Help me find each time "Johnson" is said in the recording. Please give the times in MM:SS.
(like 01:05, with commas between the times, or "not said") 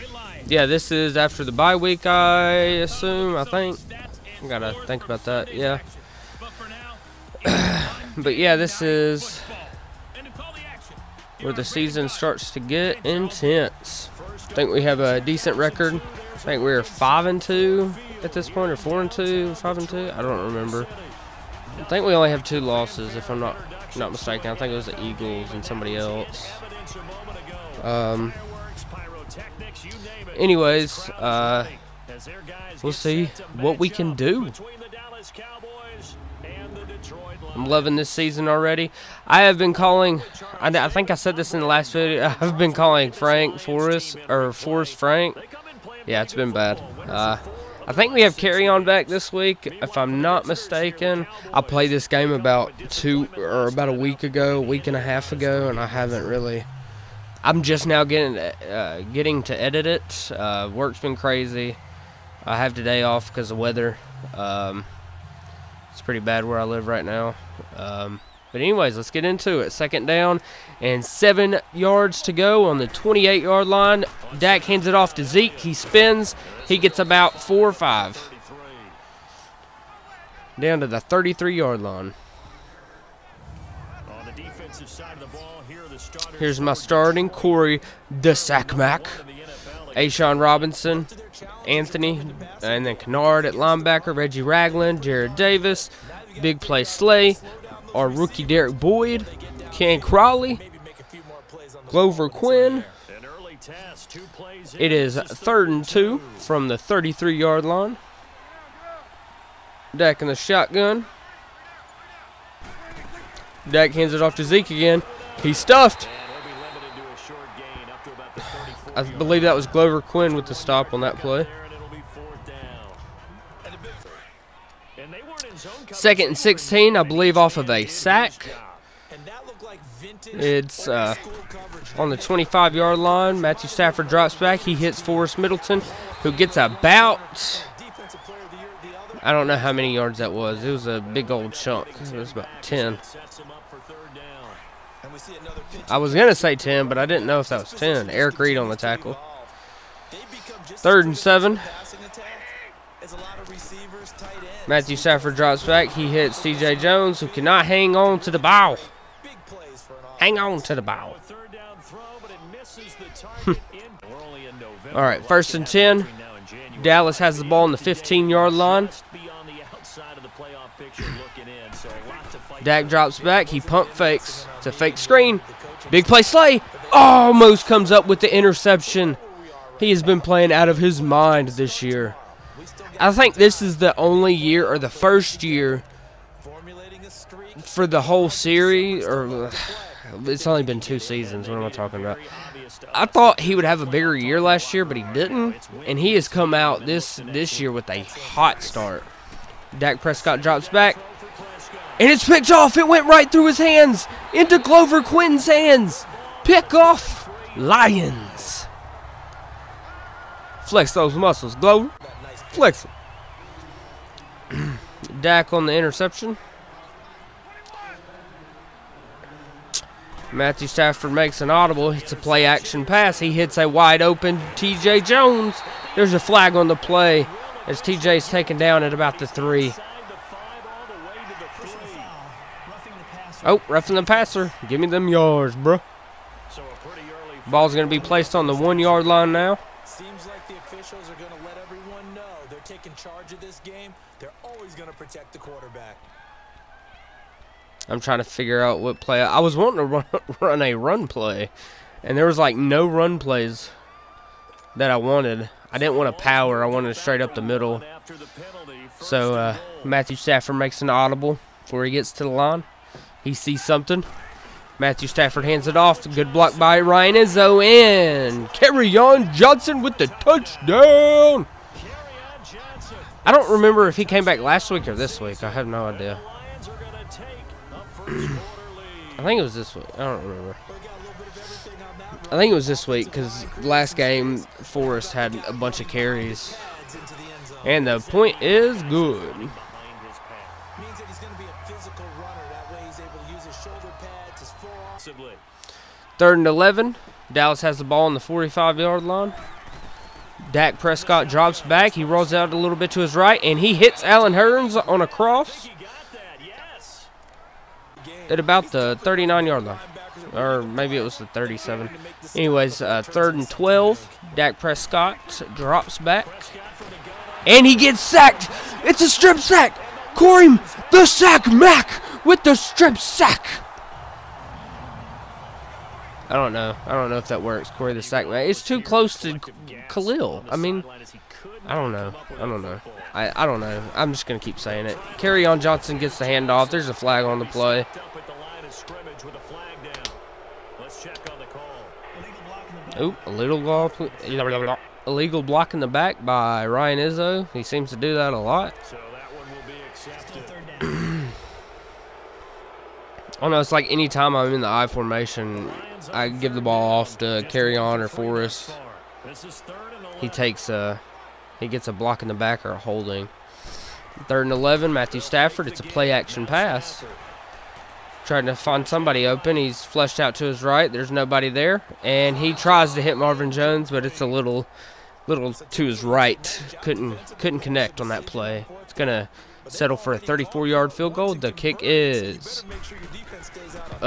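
04:29, 05:35.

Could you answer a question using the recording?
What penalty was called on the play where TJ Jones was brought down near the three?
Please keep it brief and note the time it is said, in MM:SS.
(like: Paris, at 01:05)
Roughing the passer, at 03:53.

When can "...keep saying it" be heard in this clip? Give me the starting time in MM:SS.
05:34.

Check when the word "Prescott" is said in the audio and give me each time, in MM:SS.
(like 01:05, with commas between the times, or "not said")
03:20, 05:00, 05:14.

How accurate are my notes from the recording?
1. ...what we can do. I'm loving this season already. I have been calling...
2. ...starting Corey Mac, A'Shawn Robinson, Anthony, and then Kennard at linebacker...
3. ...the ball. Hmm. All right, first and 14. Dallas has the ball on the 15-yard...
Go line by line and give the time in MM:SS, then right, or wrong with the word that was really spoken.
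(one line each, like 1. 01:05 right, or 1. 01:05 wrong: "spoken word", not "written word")
1. 00:33 right
2. 01:26 right
3. 02:40 wrong: "10", not "14".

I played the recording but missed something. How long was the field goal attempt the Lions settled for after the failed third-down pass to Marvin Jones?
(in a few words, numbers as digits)
34 yards.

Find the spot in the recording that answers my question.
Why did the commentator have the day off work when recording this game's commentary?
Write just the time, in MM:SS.
01:03.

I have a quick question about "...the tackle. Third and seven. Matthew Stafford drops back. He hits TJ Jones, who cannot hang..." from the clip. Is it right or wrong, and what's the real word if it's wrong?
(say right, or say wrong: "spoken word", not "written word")
right.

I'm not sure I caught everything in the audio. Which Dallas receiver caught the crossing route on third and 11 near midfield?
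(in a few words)
Allen Hurns.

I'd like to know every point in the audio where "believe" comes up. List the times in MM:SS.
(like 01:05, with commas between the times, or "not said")
01:59, 02:07.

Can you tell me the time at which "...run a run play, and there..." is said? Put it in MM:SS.
04:10.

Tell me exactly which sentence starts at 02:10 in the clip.
It's uh, on the 25-yard line.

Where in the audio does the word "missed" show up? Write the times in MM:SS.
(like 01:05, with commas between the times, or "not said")
not said.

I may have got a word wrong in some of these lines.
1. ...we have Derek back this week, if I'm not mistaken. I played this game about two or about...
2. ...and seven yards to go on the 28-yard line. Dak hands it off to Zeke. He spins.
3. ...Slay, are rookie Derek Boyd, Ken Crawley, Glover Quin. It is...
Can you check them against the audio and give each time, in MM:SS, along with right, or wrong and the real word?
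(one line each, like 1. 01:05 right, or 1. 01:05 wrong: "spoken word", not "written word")
1. 00:48 wrong: "Kerryon", not "Derek"
2. 01:10 right
3. 01:36 right.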